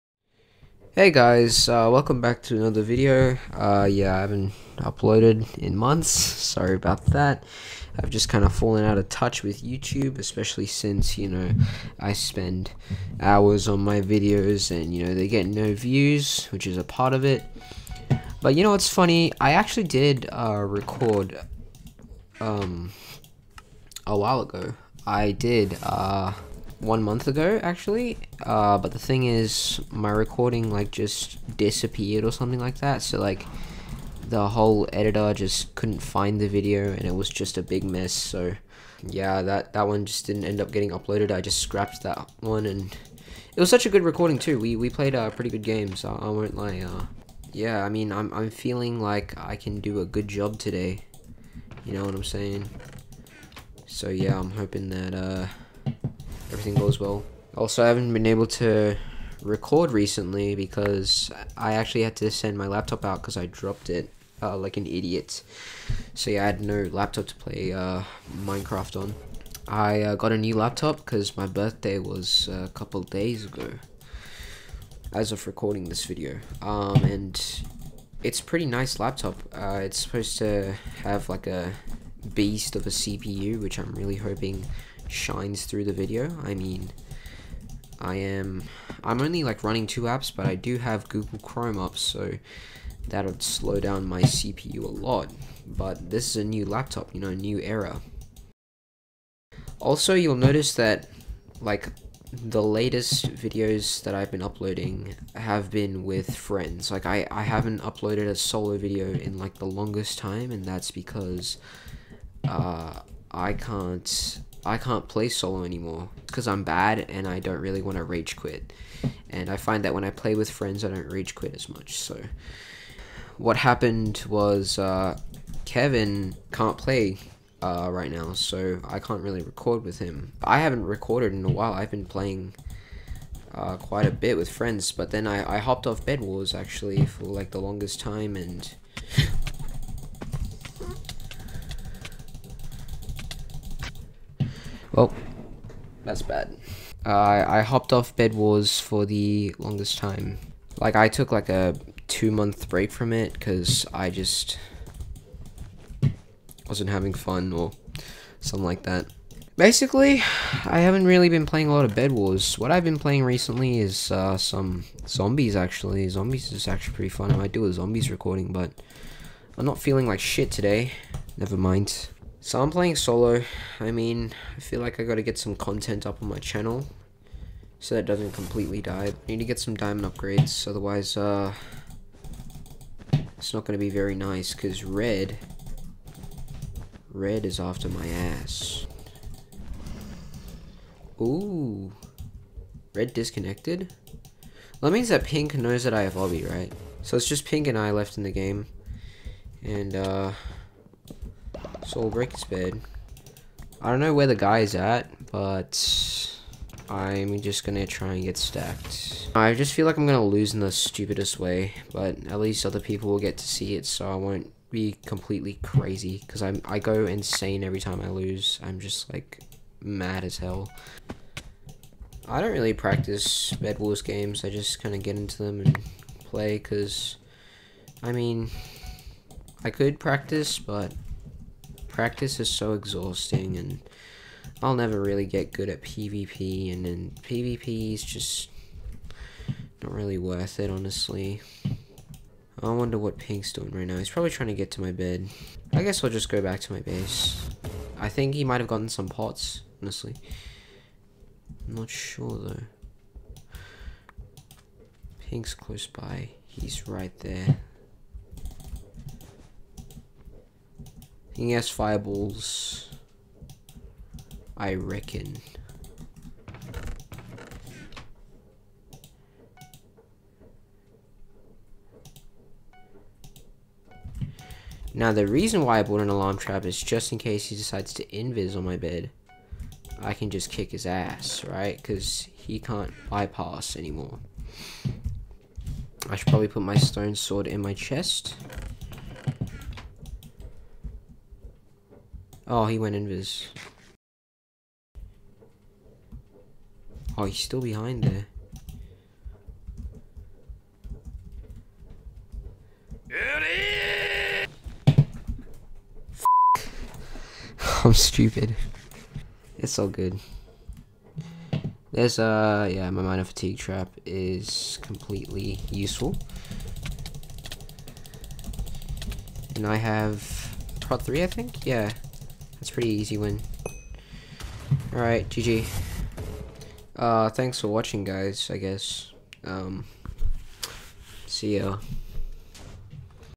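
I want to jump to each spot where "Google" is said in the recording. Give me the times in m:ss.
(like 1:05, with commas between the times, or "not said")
1:31.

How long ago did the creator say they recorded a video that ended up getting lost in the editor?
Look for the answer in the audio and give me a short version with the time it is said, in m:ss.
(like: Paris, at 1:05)
1 month ago, at 0:26.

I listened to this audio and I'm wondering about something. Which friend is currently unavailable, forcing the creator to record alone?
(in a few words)
Kevin.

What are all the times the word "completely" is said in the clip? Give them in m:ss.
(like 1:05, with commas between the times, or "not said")
2:58, 3:35, 5:14.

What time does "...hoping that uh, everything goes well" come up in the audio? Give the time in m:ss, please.
0:54.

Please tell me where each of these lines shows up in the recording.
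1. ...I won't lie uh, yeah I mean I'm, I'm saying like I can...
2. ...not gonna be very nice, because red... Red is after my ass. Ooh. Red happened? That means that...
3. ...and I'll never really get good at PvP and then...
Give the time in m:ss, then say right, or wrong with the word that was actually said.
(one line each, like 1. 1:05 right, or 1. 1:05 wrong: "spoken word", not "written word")
1. 0:46 wrong: "feeling", not "saying"
2. 3:03 wrong: "disconnected", not "happened"
3. 3:53 right.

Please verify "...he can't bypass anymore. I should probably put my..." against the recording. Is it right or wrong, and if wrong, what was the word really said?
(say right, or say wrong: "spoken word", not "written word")
right.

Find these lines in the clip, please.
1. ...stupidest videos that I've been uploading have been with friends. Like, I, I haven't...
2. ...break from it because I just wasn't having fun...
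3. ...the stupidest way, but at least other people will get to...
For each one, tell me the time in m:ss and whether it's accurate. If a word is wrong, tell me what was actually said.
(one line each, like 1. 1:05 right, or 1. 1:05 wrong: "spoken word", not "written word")
1. 1:42 wrong: "latest", not "stupidest"
2. 2:32 right
3. 3:30 right.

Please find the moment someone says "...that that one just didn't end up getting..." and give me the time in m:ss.
0:39.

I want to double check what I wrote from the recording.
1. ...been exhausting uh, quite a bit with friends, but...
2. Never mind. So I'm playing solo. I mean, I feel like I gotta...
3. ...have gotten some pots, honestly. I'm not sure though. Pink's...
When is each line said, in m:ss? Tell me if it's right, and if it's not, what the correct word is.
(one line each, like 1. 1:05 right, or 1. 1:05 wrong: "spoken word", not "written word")
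1. 2:11 wrong: "playing", not "exhausting"
2. 2:51 right
3. 4:08 right.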